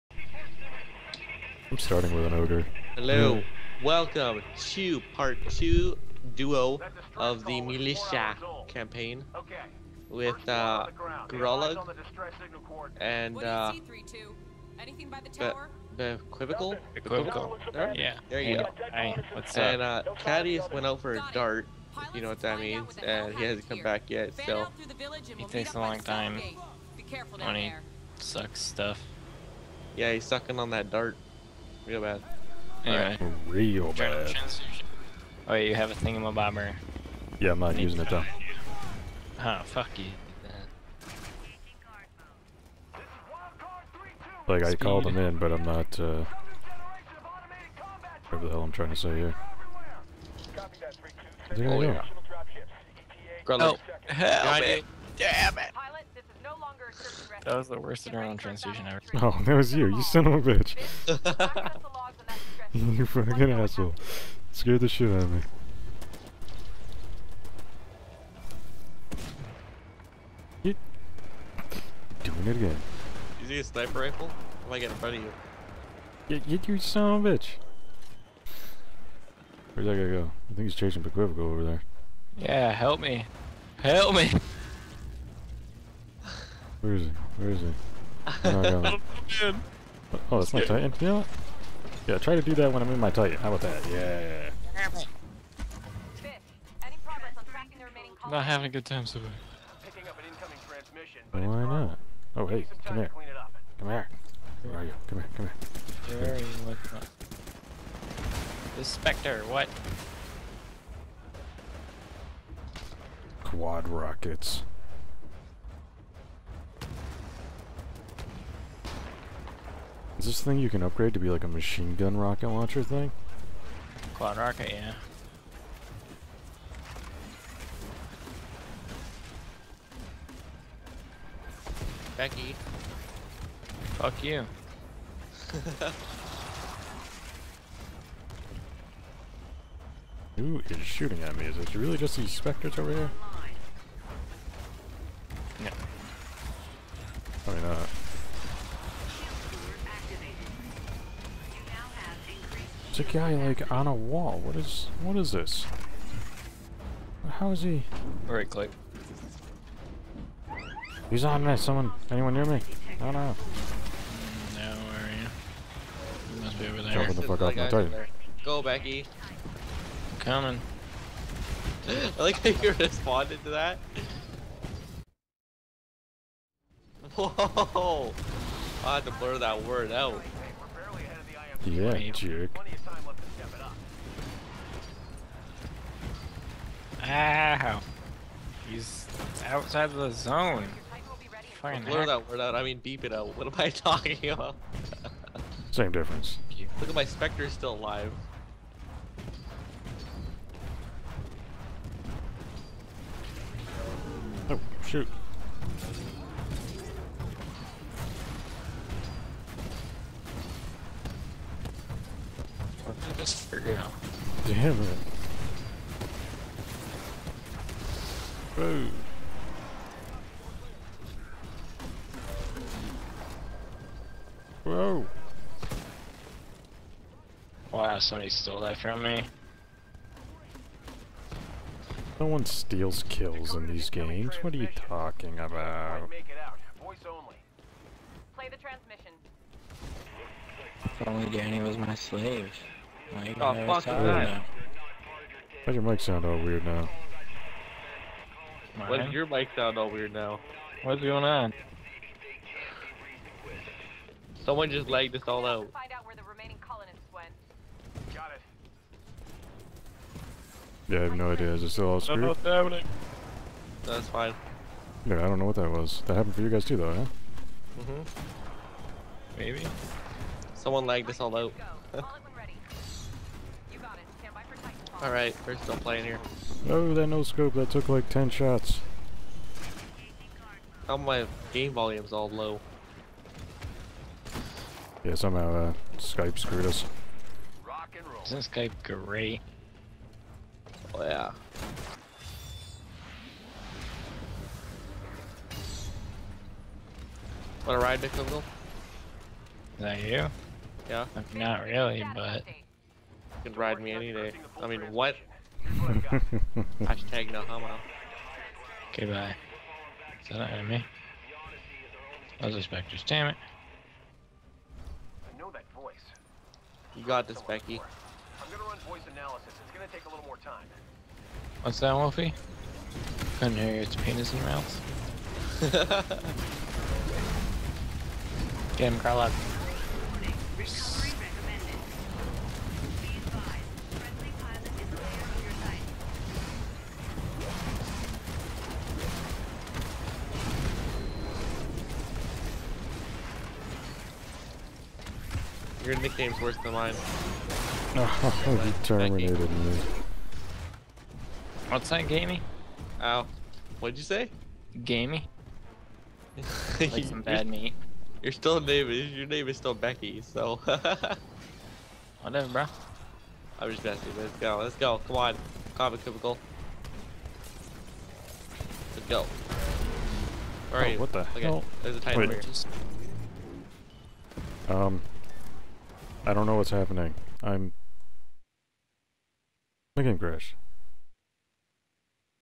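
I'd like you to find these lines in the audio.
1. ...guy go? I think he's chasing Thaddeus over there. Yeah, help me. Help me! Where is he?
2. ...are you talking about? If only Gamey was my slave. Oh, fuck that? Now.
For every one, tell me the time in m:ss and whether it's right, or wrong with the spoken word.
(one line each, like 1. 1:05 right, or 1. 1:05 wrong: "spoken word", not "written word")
1. 1:19 wrong: "Pequivico", not "Thaddeus"
2. 3:54 wrong: "Danny", not "Gamey".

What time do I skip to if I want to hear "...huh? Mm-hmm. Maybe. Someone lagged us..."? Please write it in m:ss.
4:26.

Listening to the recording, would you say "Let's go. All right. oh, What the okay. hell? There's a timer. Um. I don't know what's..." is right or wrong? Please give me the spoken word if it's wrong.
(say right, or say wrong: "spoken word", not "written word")
right.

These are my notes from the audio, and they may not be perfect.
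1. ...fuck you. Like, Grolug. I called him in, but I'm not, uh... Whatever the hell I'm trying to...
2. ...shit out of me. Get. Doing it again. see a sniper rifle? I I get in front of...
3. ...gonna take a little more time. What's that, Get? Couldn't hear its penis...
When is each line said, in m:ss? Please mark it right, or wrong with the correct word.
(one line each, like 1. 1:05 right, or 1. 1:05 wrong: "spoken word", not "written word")
1. 0:39 wrong: "Speed", not "Grolug"
2. 1:04 right
3. 5:19 wrong: "Wolfie", not "Get".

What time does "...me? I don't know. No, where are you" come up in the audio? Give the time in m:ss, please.
2:42.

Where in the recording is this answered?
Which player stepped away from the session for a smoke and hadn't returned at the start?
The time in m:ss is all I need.
0:20.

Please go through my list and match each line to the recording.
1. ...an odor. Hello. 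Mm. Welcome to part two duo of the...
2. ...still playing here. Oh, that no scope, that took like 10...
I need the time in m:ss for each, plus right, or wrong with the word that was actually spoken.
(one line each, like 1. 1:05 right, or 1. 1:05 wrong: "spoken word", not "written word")
1. 0:02 right
2. 4:35 right.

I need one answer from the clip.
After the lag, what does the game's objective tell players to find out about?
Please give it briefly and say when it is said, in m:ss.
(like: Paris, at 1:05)
Remaining colonists, at 4:16.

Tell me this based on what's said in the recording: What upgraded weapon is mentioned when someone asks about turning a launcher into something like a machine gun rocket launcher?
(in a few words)
Quad rockets.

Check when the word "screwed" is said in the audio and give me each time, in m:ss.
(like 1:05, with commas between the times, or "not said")
4:21, 4:46.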